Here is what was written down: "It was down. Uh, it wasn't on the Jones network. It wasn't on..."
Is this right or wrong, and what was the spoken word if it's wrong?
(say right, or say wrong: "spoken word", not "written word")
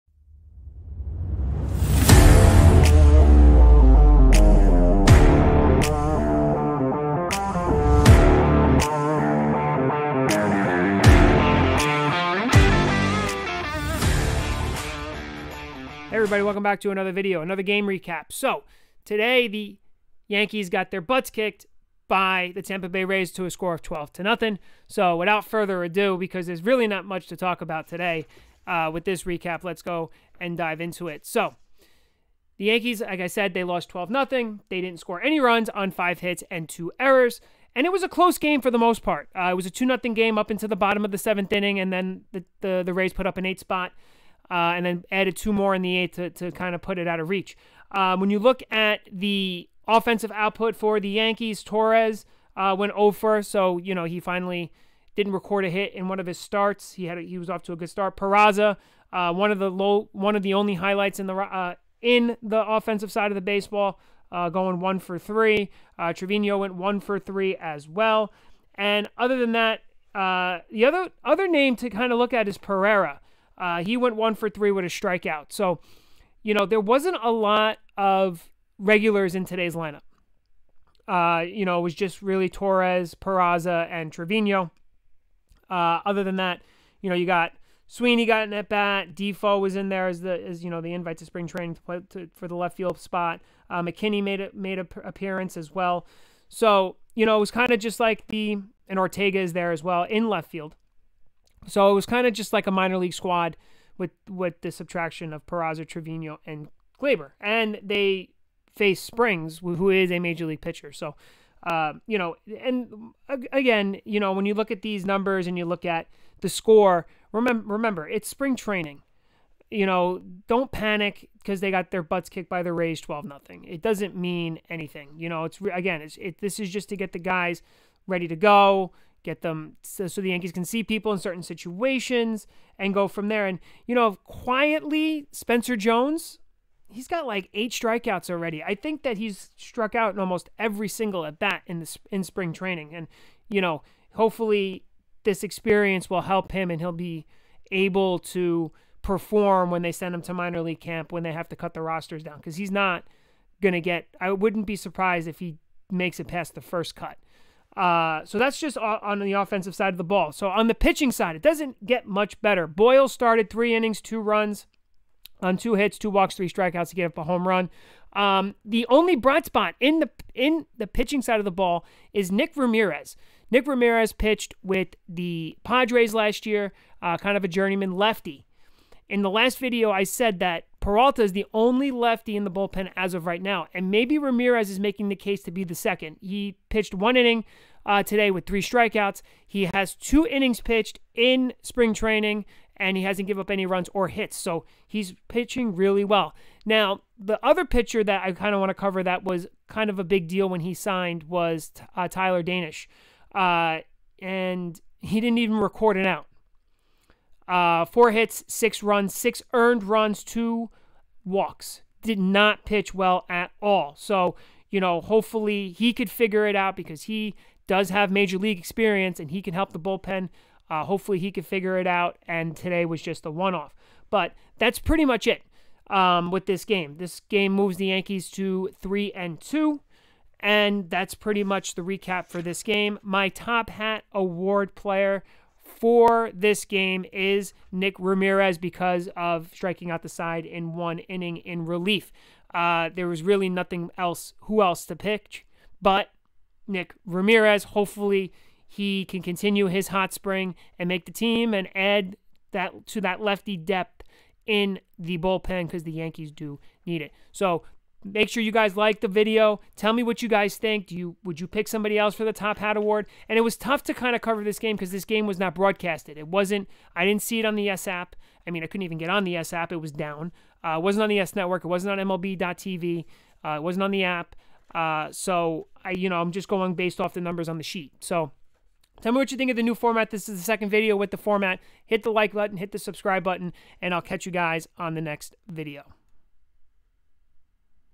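wrong: "YES", not "Jones".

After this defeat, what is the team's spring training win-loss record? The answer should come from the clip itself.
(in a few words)
3-2.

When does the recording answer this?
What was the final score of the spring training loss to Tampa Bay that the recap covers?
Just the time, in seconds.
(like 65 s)
23 s.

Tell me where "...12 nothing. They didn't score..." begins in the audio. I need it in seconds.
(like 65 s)
33 s.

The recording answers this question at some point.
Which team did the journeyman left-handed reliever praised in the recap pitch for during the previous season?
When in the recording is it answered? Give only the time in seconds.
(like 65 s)
175 s.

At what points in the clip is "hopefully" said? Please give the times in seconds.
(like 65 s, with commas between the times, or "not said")
144 s, 215 s, 220 s, 247 s.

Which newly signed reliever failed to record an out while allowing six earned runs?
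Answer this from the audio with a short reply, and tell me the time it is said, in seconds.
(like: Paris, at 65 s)
Tyler Danish, at 202 s.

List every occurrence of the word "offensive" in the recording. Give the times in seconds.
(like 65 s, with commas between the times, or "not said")
49 s, 62 s, 159 s.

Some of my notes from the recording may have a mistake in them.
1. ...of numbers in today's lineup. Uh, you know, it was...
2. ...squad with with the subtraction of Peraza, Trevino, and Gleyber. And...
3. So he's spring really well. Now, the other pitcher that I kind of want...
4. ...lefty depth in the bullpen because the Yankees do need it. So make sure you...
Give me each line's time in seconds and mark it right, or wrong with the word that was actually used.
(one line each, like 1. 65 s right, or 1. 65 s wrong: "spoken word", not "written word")
1. 77 s wrong: "regulars", not "numbers"
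2. 103 s right
3. 194 s wrong: "pitching", not "spring"
4. 253 s right.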